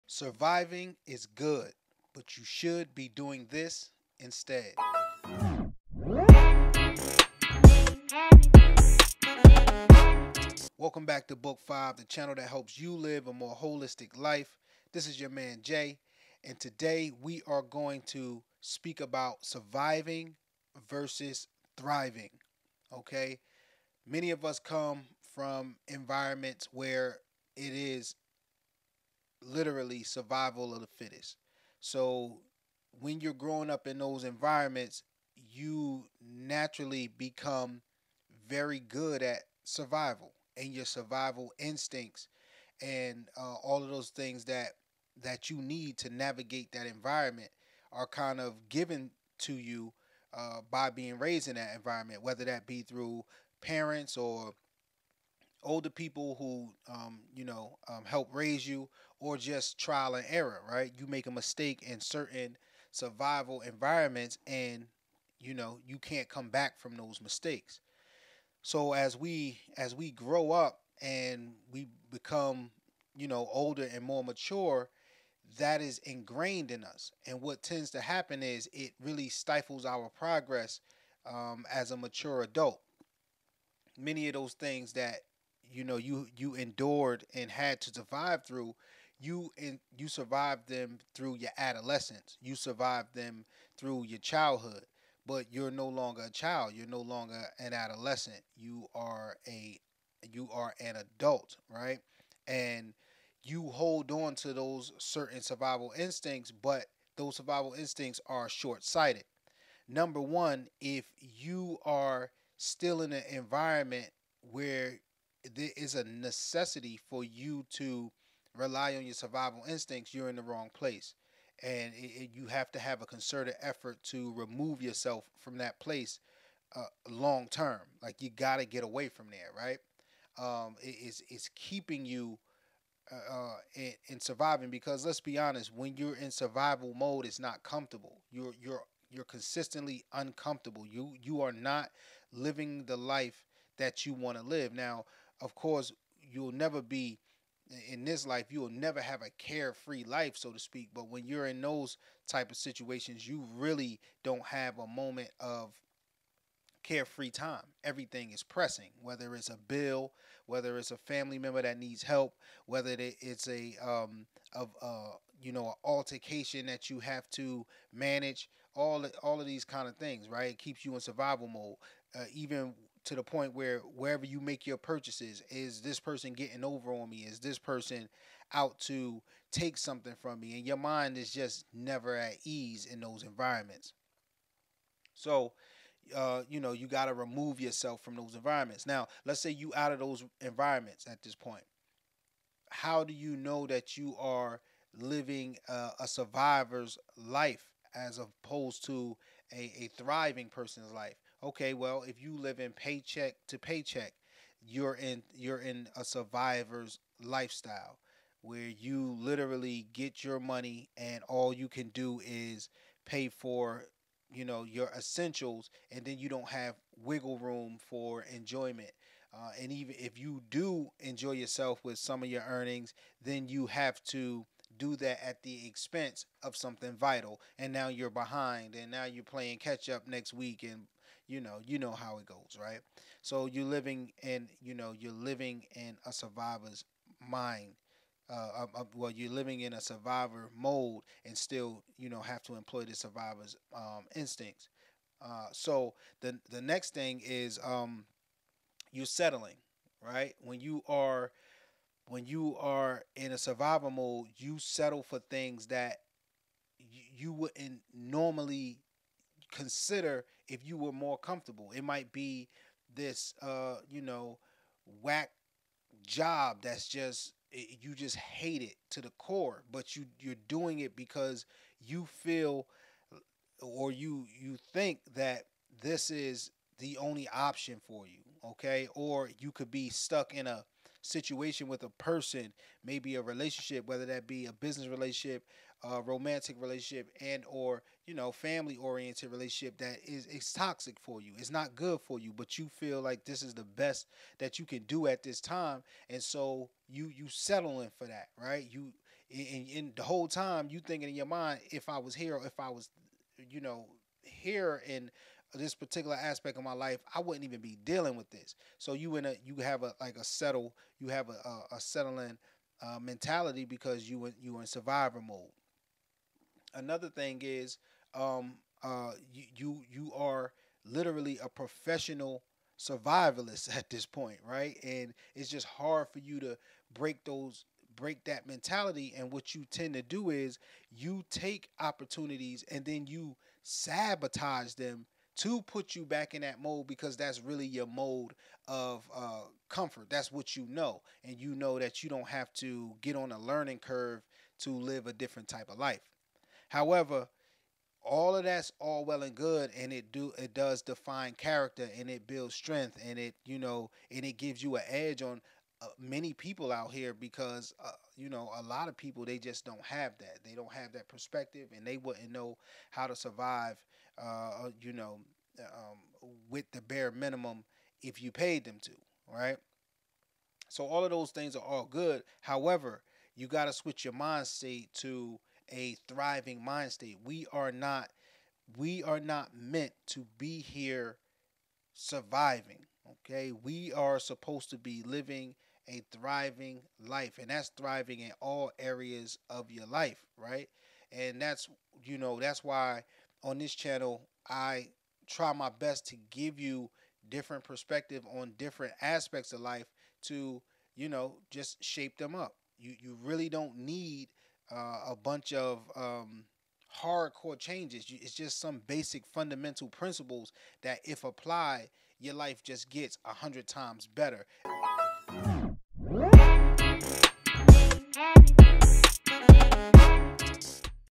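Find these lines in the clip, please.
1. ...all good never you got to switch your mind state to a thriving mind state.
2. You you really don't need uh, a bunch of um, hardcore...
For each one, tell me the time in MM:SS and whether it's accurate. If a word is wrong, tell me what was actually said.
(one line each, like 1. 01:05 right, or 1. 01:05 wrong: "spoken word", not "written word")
1. 06:11 wrong: "however", not "never"
2. 06:42 right.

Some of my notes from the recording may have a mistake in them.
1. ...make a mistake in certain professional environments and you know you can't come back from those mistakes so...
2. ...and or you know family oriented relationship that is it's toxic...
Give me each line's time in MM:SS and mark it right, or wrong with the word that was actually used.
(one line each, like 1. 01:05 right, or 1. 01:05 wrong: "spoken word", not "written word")
1. 01:01 wrong: "survival", not "professional"
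2. 04:47 right.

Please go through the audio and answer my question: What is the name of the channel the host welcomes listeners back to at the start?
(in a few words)
Book 5.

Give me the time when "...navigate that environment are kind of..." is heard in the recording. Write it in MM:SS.
00:46.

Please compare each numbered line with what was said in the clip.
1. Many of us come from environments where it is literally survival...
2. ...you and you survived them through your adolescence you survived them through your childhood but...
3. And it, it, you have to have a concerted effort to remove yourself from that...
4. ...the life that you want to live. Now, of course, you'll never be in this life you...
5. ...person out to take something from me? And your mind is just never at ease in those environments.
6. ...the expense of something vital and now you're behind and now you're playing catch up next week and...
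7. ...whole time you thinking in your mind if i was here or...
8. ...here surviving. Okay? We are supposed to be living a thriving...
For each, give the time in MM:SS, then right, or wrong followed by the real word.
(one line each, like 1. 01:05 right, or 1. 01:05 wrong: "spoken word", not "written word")
1. 00:24 right
2. 01:29 right
3. 02:01 right
4. 02:22 right
5. 02:57 right
6. 03:45 right
7. 05:00 right
8. 06:20 right.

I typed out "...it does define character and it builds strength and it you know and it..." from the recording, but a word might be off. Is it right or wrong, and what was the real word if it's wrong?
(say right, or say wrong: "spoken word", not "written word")
right.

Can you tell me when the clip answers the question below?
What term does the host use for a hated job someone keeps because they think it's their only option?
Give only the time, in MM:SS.
04:25.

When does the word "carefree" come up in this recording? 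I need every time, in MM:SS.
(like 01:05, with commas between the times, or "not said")
02:29, 02:36.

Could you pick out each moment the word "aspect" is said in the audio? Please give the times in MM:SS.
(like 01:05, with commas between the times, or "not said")
05:06, 06:39.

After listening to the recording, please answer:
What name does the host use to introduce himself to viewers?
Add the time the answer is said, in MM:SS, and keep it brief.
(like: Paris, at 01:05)
Jay, at 00:15.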